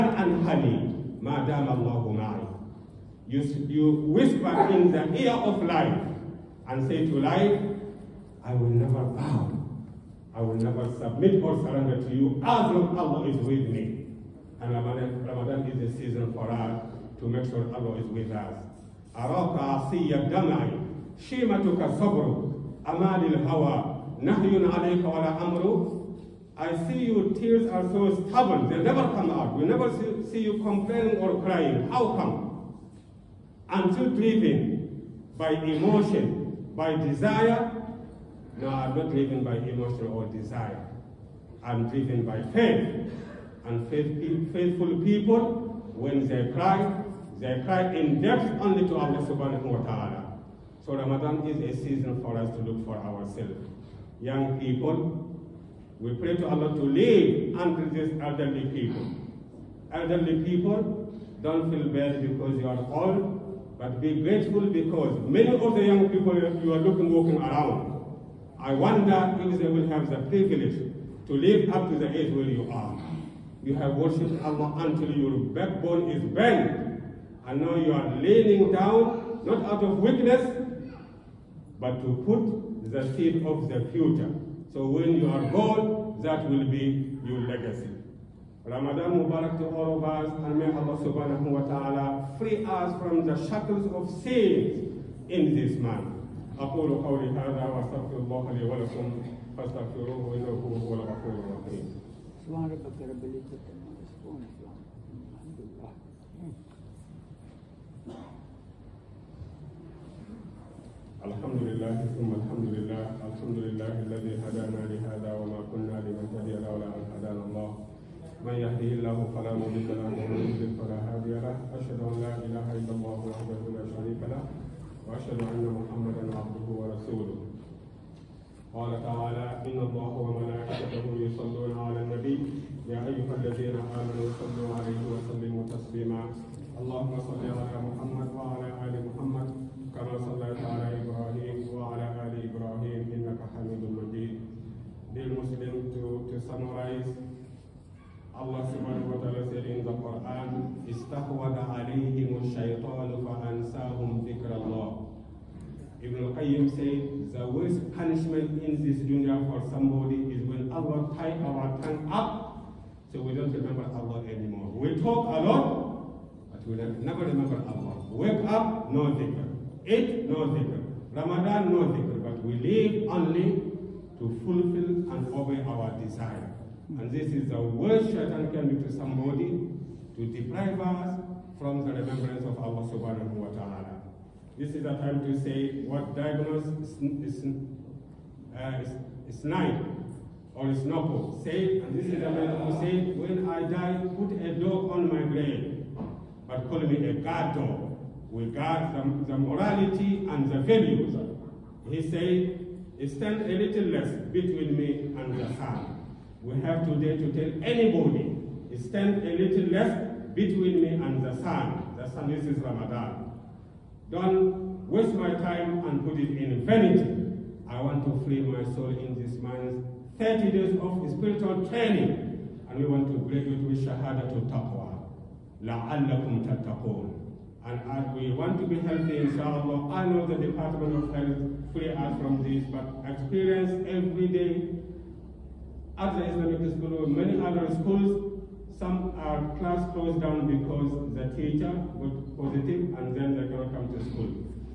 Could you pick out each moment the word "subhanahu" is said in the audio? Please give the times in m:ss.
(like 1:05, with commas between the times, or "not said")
0:49, 1:31, 2:28, 3:02.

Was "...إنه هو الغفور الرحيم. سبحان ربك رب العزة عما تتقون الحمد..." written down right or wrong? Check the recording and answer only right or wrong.
wrong.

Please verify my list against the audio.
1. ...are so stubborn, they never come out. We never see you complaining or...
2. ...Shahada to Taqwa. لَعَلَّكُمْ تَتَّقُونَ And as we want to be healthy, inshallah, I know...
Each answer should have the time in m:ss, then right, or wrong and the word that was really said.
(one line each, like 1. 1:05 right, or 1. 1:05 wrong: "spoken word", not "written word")
1. 0:27 right
2. 3:43 right.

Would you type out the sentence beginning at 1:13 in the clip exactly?
You have worshipped Allah until your backbone is bent.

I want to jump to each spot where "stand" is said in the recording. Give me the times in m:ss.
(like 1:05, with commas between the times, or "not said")
3:23, 3:28.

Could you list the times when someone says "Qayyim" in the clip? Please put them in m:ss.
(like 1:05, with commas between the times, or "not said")
2:36.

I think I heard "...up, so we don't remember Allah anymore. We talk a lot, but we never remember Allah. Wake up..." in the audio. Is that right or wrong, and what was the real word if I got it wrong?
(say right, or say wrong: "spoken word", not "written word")
right.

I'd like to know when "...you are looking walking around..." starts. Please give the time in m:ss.
1:06.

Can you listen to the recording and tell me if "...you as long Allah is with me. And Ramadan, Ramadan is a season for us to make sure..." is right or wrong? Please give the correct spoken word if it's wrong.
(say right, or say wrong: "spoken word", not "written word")
right.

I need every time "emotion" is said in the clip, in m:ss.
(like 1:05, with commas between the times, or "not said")
0:35, 0:39.